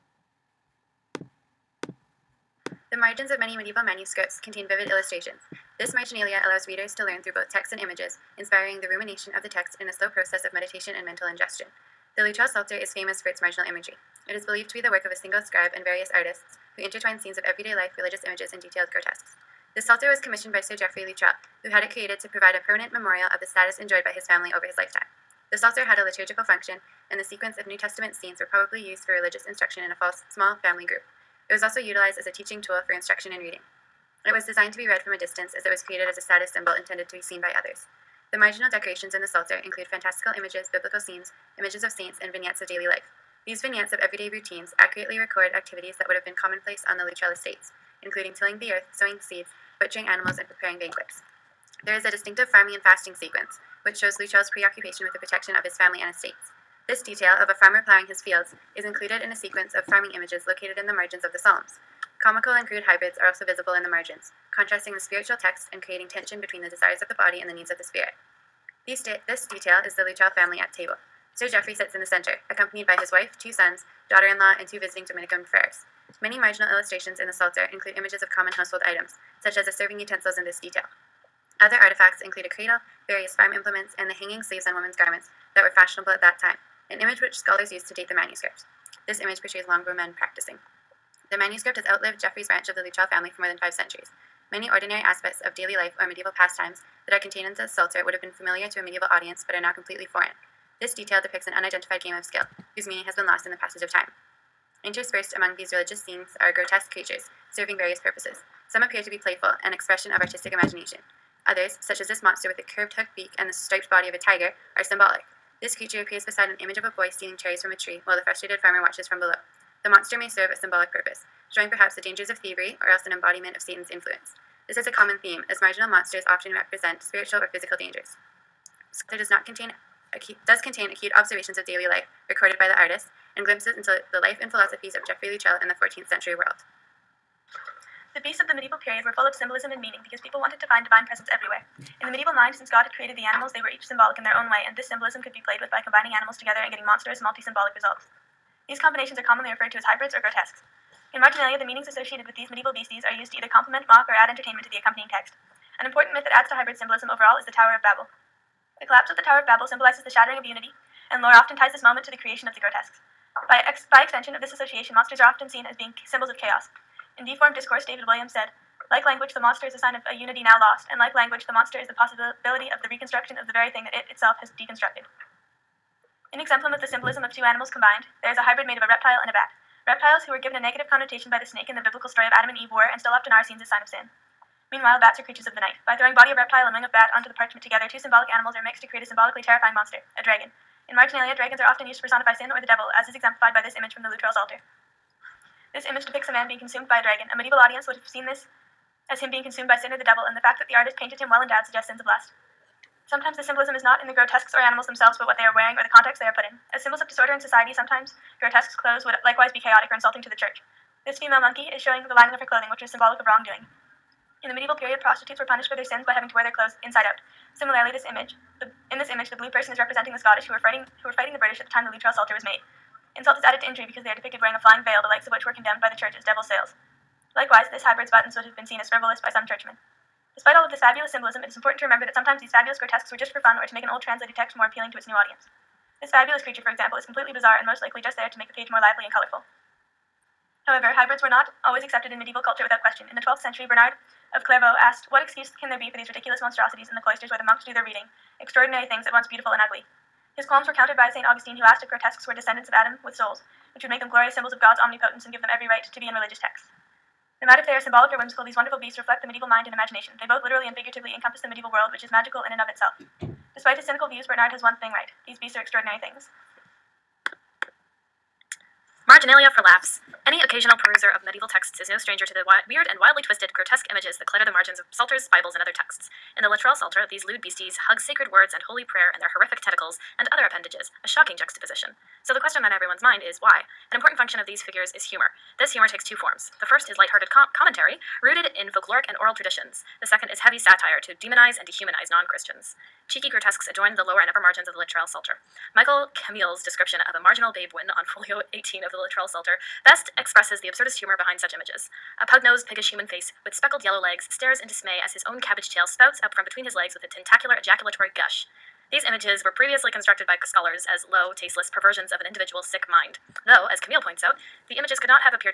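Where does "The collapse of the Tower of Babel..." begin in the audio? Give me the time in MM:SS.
02:38.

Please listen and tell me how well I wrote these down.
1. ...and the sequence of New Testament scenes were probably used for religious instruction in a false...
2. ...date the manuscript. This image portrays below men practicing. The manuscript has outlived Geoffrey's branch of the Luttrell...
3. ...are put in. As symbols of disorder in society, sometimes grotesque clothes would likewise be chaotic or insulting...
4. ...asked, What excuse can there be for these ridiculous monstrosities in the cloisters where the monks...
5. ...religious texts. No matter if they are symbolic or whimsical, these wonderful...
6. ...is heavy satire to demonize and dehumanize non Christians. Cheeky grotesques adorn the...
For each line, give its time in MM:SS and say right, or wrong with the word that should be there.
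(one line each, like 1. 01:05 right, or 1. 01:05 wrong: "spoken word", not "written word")
1. 00:27 right
2. 01:27 wrong: "longbow", not "below"
3. 03:26 right
4. 04:04 right
5. 04:16 right
6. 04:50 right.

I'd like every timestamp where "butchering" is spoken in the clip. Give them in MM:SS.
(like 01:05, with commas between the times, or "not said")
00:49.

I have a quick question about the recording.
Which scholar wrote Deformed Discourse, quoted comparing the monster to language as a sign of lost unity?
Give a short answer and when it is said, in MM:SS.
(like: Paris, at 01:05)
David Williams, at 02:47.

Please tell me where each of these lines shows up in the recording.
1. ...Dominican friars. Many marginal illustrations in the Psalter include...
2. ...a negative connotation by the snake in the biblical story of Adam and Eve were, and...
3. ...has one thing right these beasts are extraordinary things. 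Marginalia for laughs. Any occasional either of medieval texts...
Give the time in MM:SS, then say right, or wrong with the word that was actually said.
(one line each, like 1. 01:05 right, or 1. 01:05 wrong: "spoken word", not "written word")
1. 01:15 right
2. 03:00 right
3. 04:24 wrong: "peruser", not "either".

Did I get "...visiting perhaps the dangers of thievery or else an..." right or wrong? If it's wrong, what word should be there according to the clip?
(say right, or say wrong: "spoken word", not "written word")
wrong: "showing", not "visiting".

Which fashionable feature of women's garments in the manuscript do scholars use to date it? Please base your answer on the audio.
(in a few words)
Hanging sleeves.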